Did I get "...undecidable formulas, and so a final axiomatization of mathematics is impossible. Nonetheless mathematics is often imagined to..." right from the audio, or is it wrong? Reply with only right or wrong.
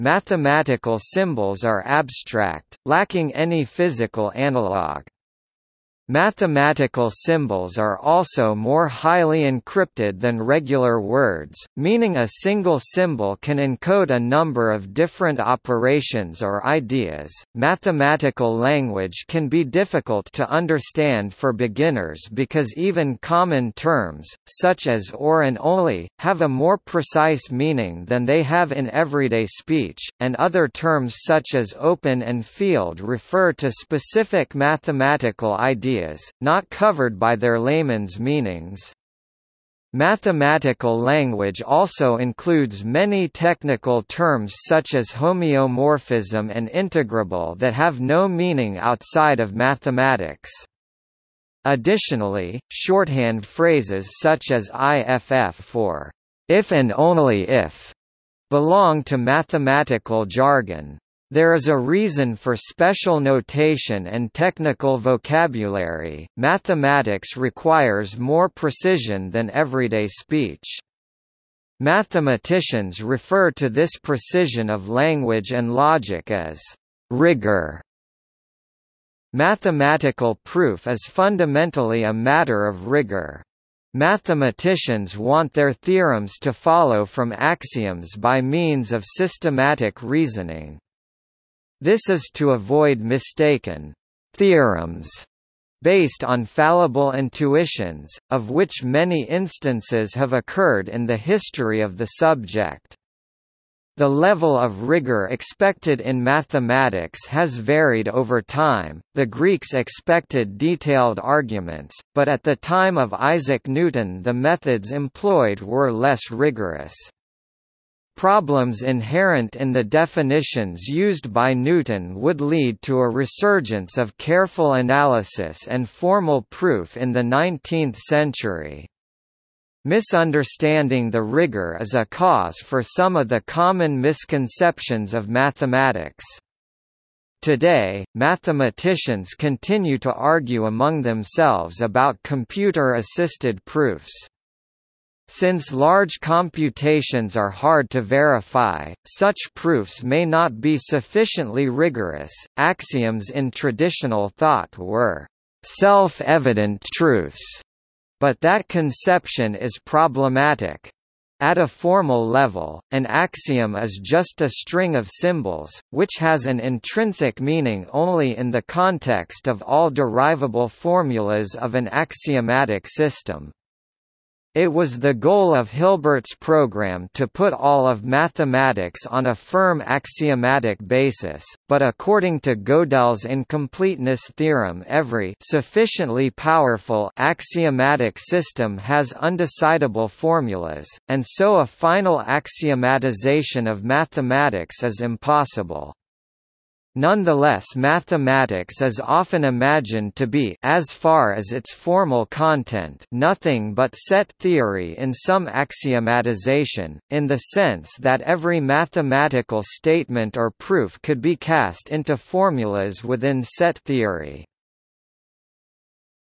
right.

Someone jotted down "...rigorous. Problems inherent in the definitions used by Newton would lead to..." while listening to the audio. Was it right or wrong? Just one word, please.
right.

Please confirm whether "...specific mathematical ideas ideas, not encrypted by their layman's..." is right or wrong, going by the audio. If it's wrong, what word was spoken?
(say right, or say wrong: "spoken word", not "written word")
wrong: "covered", not "encrypted".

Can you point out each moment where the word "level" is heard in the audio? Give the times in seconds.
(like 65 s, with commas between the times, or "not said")
104 s, 162 s.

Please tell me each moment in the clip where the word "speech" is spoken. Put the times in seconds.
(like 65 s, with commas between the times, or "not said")
29 s, 70 s.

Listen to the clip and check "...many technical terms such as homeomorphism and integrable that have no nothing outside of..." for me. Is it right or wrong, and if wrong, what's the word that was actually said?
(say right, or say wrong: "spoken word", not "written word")
wrong: "meaning", not "nothing".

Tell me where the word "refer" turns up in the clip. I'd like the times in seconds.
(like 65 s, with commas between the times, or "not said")
33 s, 73 s.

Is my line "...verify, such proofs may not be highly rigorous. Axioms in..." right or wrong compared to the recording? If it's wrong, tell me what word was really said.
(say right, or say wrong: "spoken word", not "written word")
wrong: "sufficiently", not "highly".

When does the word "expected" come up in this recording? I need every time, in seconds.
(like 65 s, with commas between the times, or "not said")
105 s, 109 s.